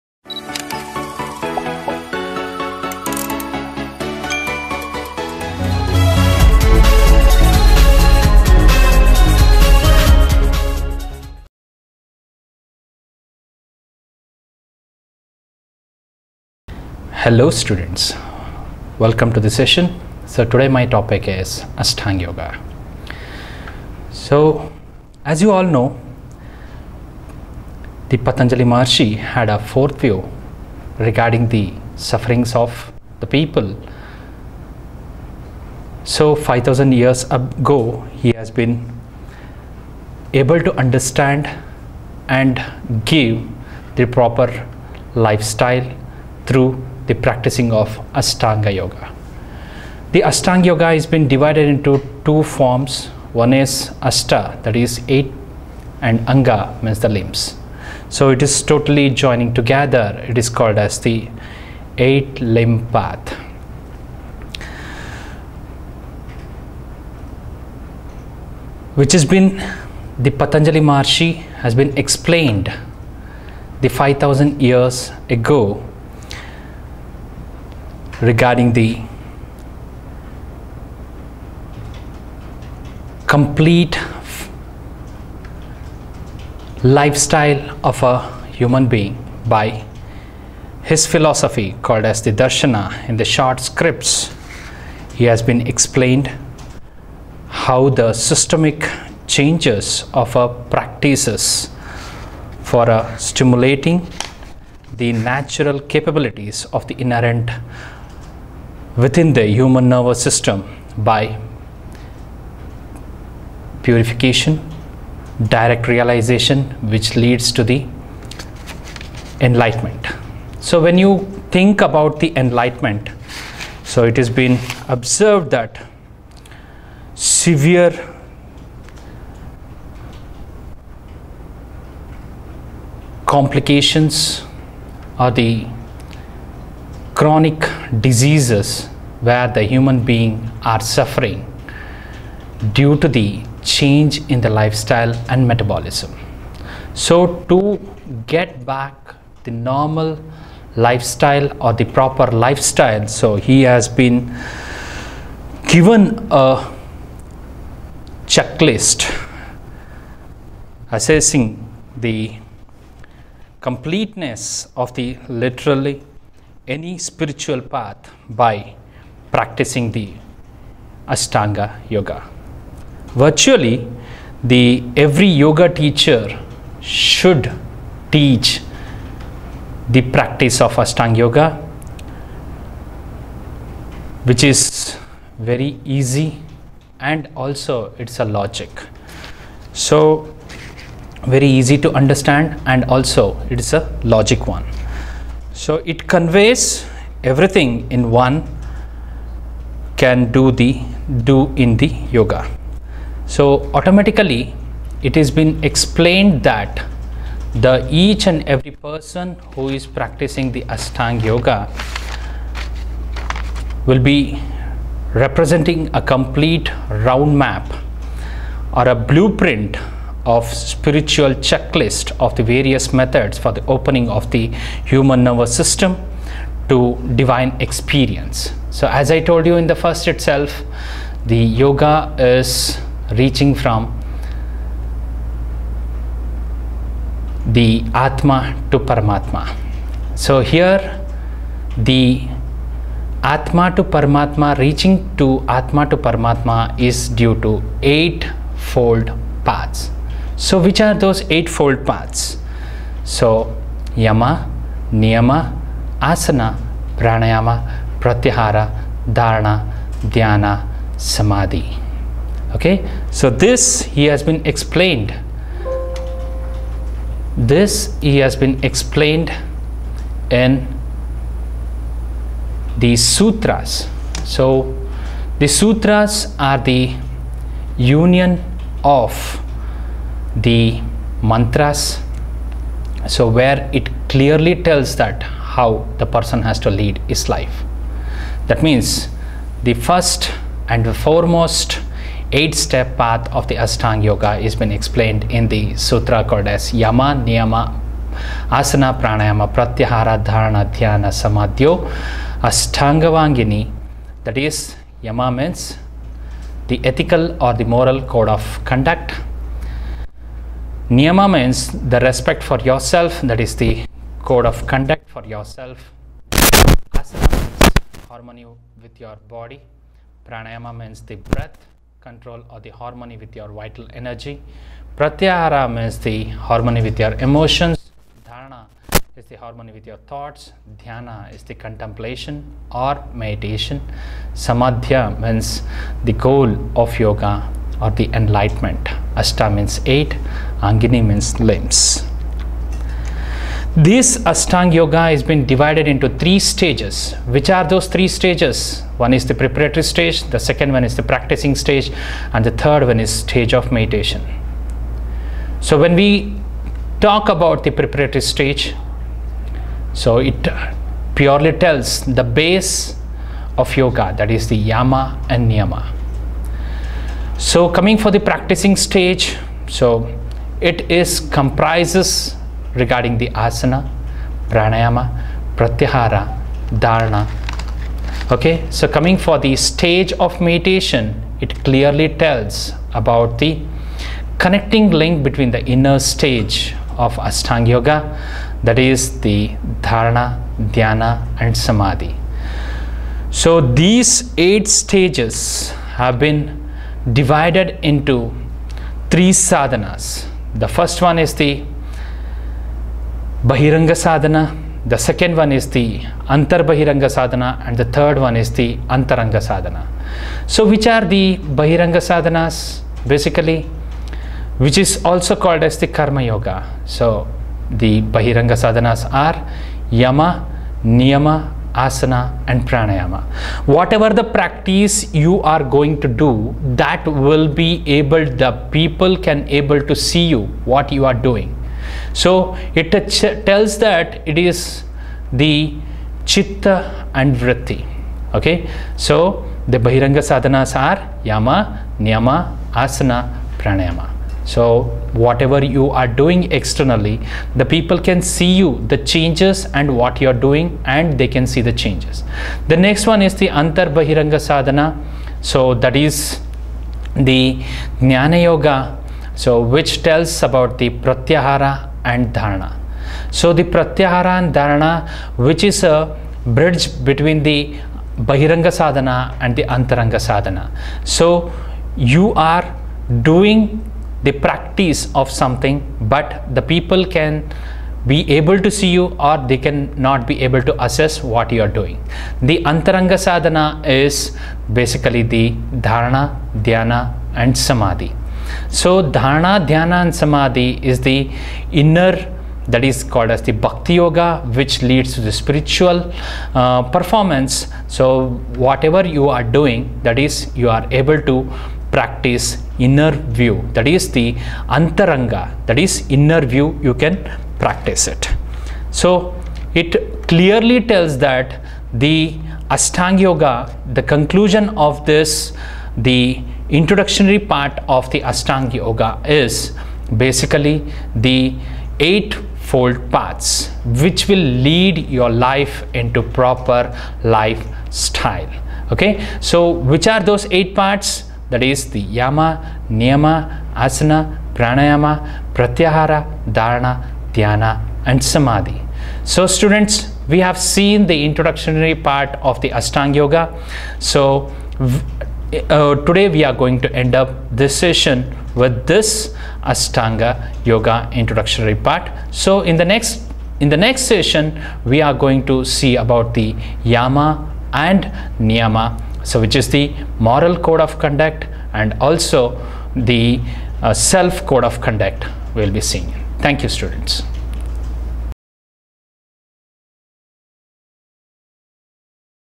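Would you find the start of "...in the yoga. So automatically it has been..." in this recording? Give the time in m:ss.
3:21.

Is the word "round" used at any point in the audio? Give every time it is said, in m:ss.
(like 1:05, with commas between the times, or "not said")
3:36.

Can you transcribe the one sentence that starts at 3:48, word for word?
So as I told you in the first itself, the yoga is reaching from the Atma to Paramatma.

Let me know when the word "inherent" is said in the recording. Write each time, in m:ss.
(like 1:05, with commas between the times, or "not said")
1:47.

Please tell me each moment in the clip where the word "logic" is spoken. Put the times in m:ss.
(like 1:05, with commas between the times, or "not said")
3:08, 3:14.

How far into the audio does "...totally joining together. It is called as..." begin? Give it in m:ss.
0:58.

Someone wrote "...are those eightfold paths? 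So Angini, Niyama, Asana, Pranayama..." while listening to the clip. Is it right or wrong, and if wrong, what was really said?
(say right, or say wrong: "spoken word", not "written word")
wrong: "Yama", not "Angini".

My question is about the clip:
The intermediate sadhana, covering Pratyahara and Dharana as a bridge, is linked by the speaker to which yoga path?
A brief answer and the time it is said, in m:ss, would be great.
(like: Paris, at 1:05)
Jnana yoga, at 7:37.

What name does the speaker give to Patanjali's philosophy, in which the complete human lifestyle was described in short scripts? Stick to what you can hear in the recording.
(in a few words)
darshana.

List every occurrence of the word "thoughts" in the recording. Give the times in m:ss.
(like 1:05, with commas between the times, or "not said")
5:30.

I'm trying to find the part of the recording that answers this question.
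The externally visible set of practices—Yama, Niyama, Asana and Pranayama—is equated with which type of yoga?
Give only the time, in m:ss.
6:55.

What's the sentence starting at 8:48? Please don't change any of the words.
Okay, so which are those eight parts?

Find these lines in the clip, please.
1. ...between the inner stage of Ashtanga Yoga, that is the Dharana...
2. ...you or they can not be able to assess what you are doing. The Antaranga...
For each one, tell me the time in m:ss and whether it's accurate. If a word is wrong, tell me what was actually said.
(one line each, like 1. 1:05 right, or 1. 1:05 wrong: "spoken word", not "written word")
1. 6:25 right
2. 7:58 right.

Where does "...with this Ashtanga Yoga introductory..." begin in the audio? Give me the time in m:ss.
9:08.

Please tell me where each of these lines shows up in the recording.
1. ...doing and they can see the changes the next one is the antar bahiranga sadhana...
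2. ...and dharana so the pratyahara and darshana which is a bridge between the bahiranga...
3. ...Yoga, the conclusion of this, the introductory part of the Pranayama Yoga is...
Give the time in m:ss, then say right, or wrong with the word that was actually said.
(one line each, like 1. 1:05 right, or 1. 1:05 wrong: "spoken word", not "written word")
1. 7:30 right
2. 7:42 wrong: "dharana", not "darshana"
3. 8:33 wrong: "Ashtanga", not "Pranayama".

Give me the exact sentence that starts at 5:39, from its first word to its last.
Ashta means eight, Angini means limbs.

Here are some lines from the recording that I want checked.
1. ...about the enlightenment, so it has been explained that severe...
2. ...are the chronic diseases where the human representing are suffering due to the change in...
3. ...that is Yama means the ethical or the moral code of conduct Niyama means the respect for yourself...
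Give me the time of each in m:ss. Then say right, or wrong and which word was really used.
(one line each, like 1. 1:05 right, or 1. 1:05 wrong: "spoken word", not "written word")
1. 2:01 wrong: "observed", not "explained"
2. 2:15 wrong: "being", not "representing"
3. 5:04 right.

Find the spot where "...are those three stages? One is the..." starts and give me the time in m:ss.
5:47.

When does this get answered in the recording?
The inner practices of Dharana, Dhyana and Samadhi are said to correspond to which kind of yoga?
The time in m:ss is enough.
8:13.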